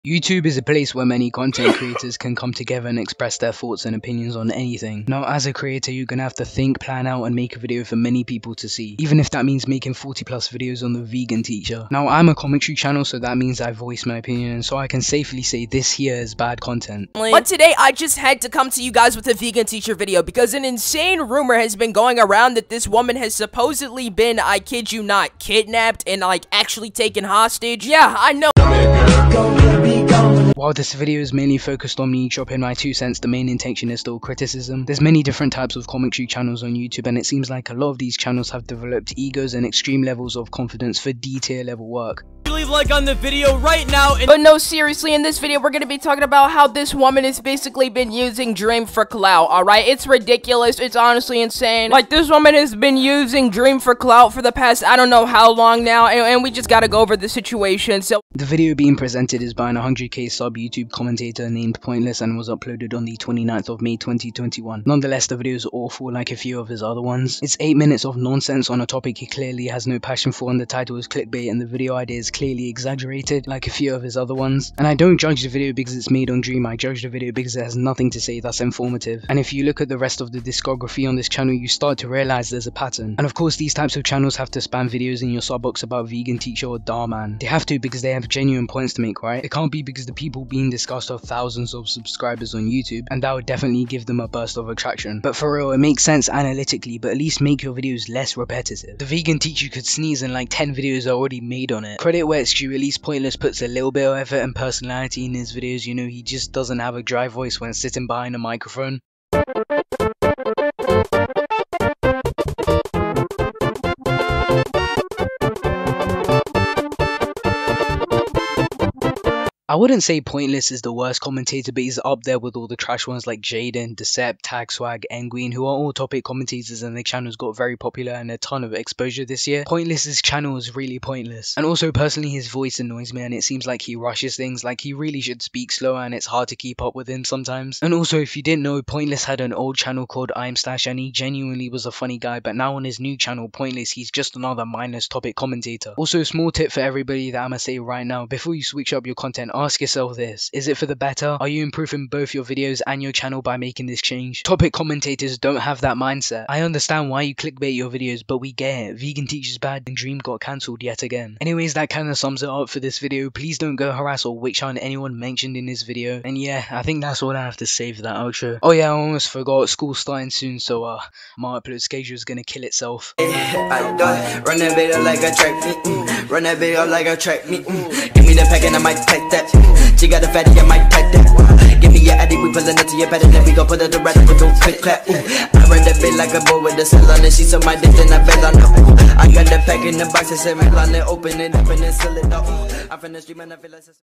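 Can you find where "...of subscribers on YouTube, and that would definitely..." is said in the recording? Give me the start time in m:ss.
1:31.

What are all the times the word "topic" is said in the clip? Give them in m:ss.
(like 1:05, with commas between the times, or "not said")
1:08, 2:05, 2:25, 2:34.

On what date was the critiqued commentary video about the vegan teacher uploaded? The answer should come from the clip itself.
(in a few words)
29 May 2021.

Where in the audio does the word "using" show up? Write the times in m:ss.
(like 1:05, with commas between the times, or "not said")
0:48, 0:52.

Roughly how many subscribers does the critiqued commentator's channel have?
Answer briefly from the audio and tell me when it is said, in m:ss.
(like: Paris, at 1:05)
100k, at 0:59.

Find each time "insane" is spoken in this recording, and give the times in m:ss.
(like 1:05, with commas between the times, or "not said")
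0:20, 0:51.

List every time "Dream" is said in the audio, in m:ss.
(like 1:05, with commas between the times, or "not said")
0:48, 0:53, 1:16, 2:39.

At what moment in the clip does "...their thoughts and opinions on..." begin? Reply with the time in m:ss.
0:03.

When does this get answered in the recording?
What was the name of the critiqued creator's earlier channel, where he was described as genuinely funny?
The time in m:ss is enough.
2:20.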